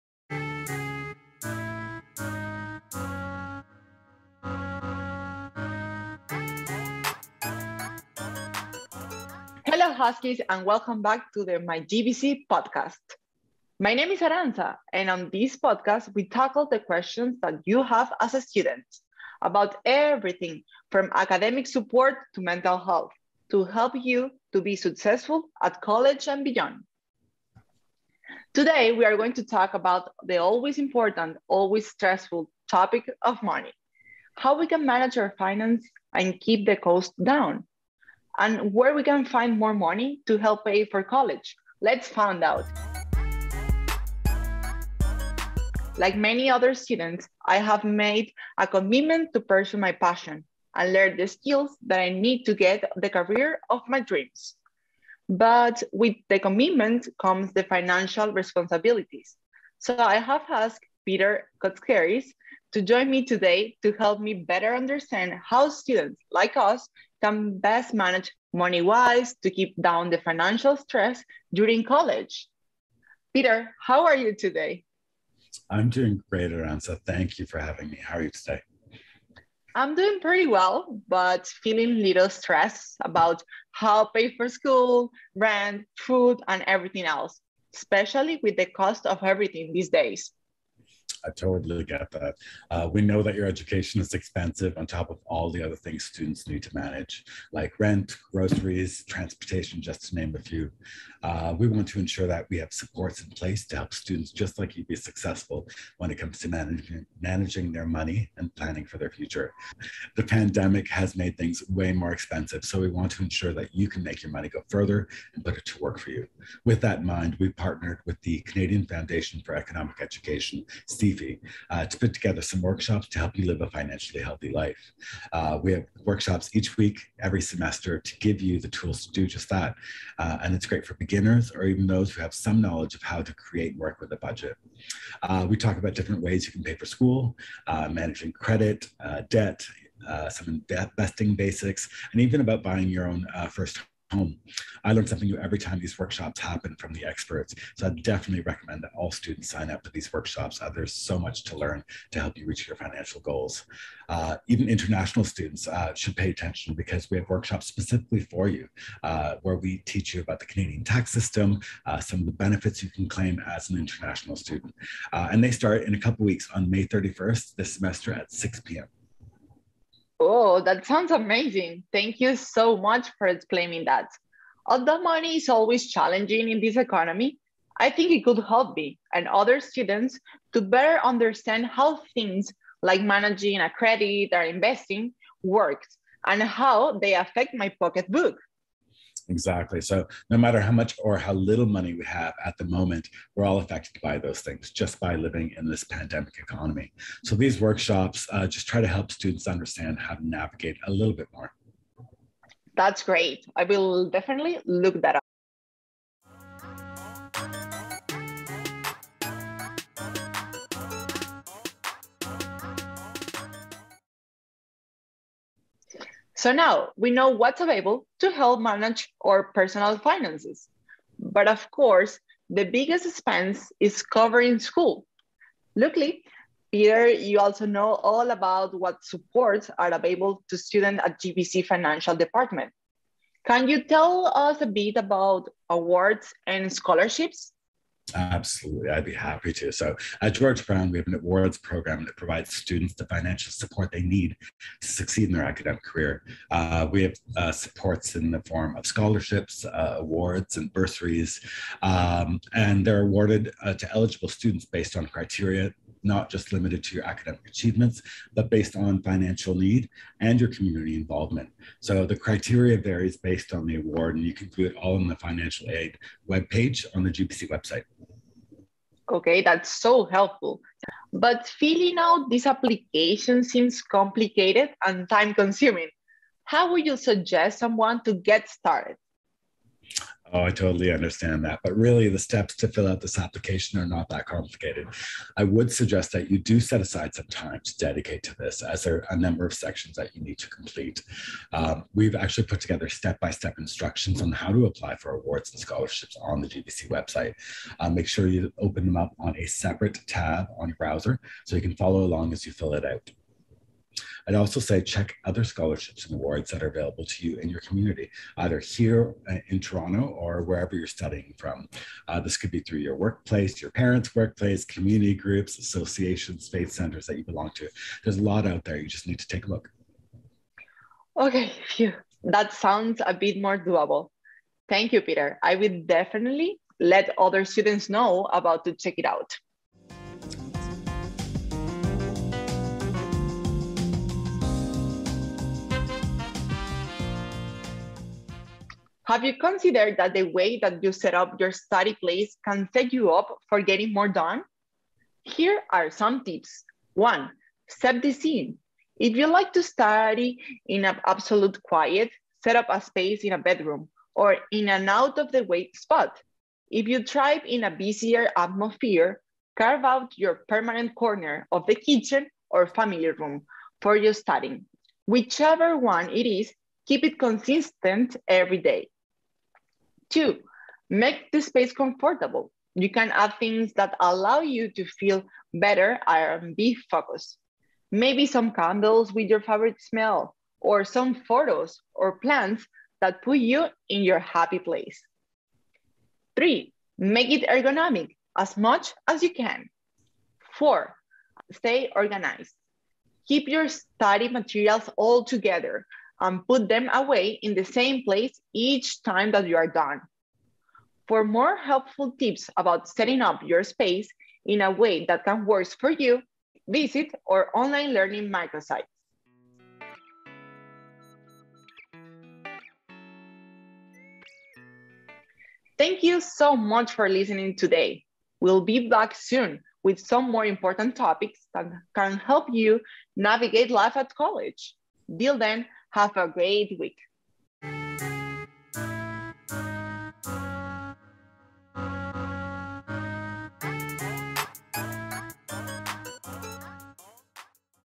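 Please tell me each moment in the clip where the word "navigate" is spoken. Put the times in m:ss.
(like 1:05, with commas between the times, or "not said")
3:20, 7:03.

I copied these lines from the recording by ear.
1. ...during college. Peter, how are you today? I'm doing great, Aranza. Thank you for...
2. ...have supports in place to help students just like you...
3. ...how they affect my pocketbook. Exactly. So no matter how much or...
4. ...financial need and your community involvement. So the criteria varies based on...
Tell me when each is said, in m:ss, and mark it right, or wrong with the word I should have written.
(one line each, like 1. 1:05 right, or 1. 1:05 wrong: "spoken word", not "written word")
1. 1:11 right
2. 1:42 right
3. 3:06 right
4. 4:19 right.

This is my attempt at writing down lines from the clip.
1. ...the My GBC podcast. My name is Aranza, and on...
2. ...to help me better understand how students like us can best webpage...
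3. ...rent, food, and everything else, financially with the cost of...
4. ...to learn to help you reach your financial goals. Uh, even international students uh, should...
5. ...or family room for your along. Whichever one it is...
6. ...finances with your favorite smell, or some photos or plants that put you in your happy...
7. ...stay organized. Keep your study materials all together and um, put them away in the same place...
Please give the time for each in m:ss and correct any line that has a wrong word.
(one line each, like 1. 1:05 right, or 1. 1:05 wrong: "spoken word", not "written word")
1. 0:11 right
2. 1:03 wrong: "manage", not "webpage"
3. 1:25 wrong: "especially", not "financially"
4. 2:31 right
5. 6:02 wrong: "studying", not "along"
6. 6:18 wrong: "candles", not "finances"
7. 6:31 right.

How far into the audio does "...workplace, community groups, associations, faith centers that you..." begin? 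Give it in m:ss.
5:14.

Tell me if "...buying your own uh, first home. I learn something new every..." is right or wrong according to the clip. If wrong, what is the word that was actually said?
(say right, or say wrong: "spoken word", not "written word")
right.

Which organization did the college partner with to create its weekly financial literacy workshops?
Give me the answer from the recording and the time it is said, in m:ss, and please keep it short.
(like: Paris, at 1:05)
Canadian Foundation for Economic Education, at 1:58.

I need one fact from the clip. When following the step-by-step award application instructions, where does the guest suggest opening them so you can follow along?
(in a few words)
a separate tab.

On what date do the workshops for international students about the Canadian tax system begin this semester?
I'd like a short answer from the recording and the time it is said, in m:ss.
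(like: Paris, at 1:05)
May 31st, at 2:46.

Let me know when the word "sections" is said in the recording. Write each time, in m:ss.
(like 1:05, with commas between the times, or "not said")
4:49.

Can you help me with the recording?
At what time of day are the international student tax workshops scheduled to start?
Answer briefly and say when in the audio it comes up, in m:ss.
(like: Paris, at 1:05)
6 p.m., at 2:48.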